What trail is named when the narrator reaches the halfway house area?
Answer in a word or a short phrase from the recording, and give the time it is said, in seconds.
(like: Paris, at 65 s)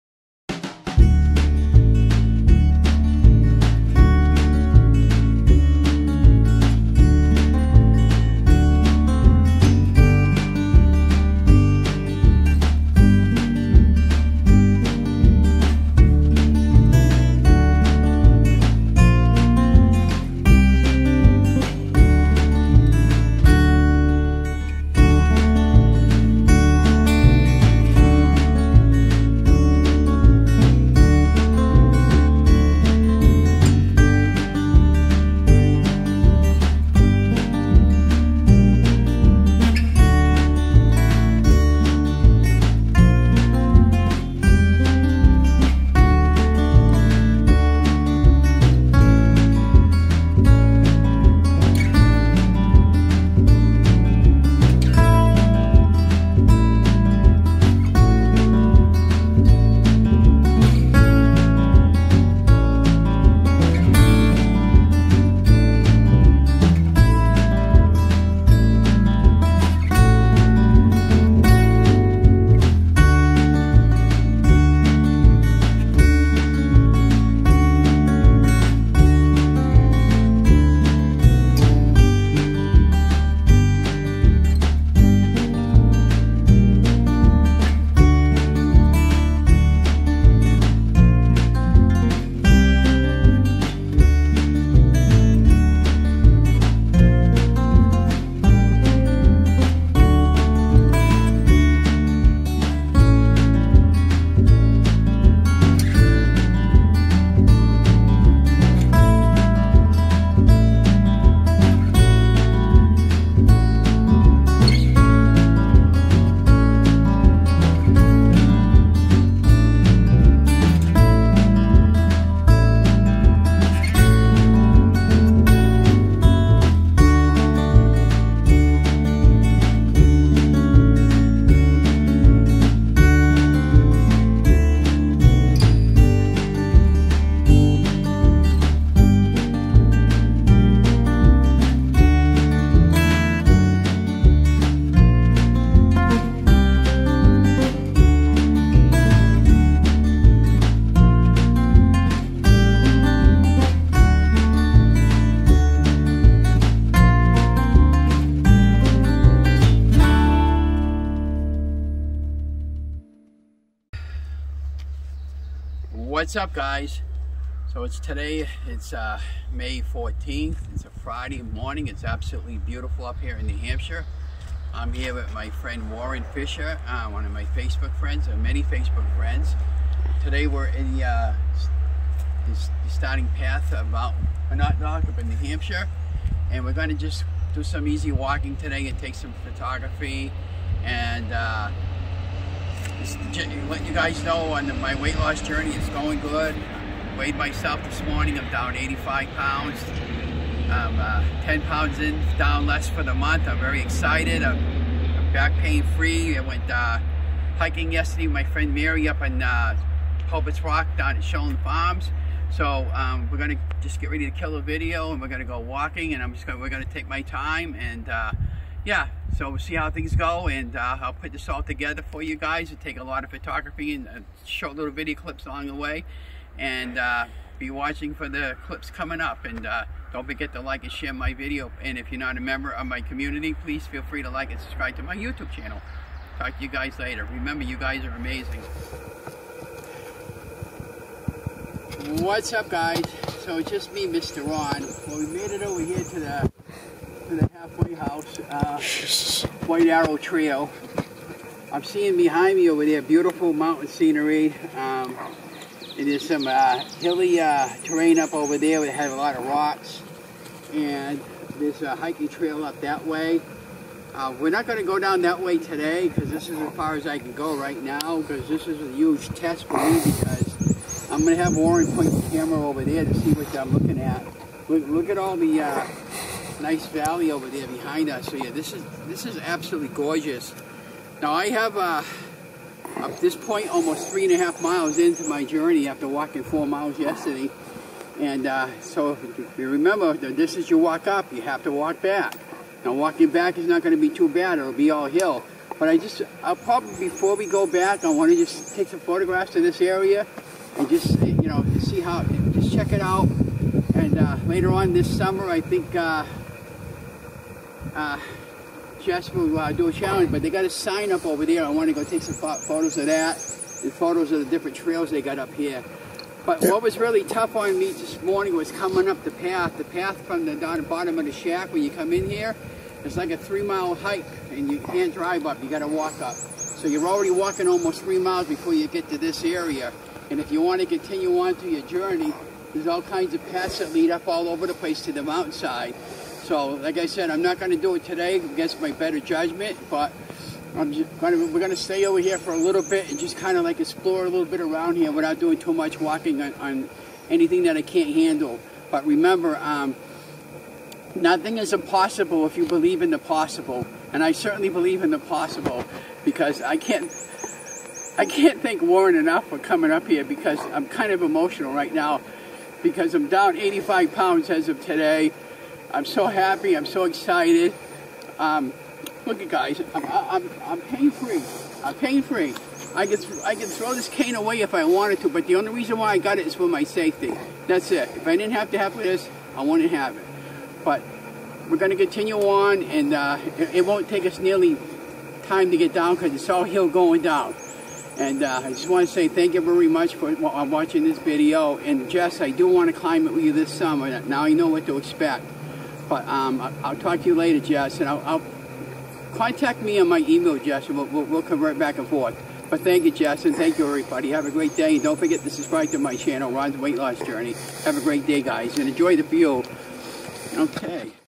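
White Arrow Trail, at 249 s.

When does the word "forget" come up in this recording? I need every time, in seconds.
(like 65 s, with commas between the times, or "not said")
230 s, 405 s.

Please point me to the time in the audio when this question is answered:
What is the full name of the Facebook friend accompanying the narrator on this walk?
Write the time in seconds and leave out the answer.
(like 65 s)
175 s.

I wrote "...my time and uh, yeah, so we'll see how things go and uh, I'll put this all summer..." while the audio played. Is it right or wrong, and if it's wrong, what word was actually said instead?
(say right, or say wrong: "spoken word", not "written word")
wrong: "together", not "summer".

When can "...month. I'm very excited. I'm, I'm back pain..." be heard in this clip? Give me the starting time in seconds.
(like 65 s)
203 s.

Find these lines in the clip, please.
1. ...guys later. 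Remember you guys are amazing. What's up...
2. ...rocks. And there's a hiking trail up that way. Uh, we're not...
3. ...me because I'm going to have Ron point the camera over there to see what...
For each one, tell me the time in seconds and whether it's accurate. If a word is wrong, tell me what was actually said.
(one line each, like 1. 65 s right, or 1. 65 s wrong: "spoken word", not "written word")
1. 236 s right
2. 259 s right
3. 269 s wrong: "Warren", not "Ron".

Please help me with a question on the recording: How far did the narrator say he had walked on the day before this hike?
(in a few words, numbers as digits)
4 miles.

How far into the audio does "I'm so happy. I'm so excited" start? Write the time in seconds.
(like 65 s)
365 s.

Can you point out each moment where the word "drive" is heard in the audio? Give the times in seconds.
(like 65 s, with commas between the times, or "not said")
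325 s.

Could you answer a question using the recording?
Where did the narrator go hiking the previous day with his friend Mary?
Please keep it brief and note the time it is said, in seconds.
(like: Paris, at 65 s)
Sheldon Farms, at 211 s.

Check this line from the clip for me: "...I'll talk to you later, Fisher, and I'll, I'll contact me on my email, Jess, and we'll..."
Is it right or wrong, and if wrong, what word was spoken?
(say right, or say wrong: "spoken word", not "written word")
wrong: "Jess", not "Fisher".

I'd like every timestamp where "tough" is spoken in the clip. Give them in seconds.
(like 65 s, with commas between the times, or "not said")
317 s.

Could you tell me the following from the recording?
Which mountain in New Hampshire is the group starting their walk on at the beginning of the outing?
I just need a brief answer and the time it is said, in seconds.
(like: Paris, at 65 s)
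Mount Monadnock, at 183 s.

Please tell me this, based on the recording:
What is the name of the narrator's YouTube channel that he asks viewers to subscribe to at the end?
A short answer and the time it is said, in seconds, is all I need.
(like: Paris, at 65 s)
Ron's Weight Loss Journey, at 406 s.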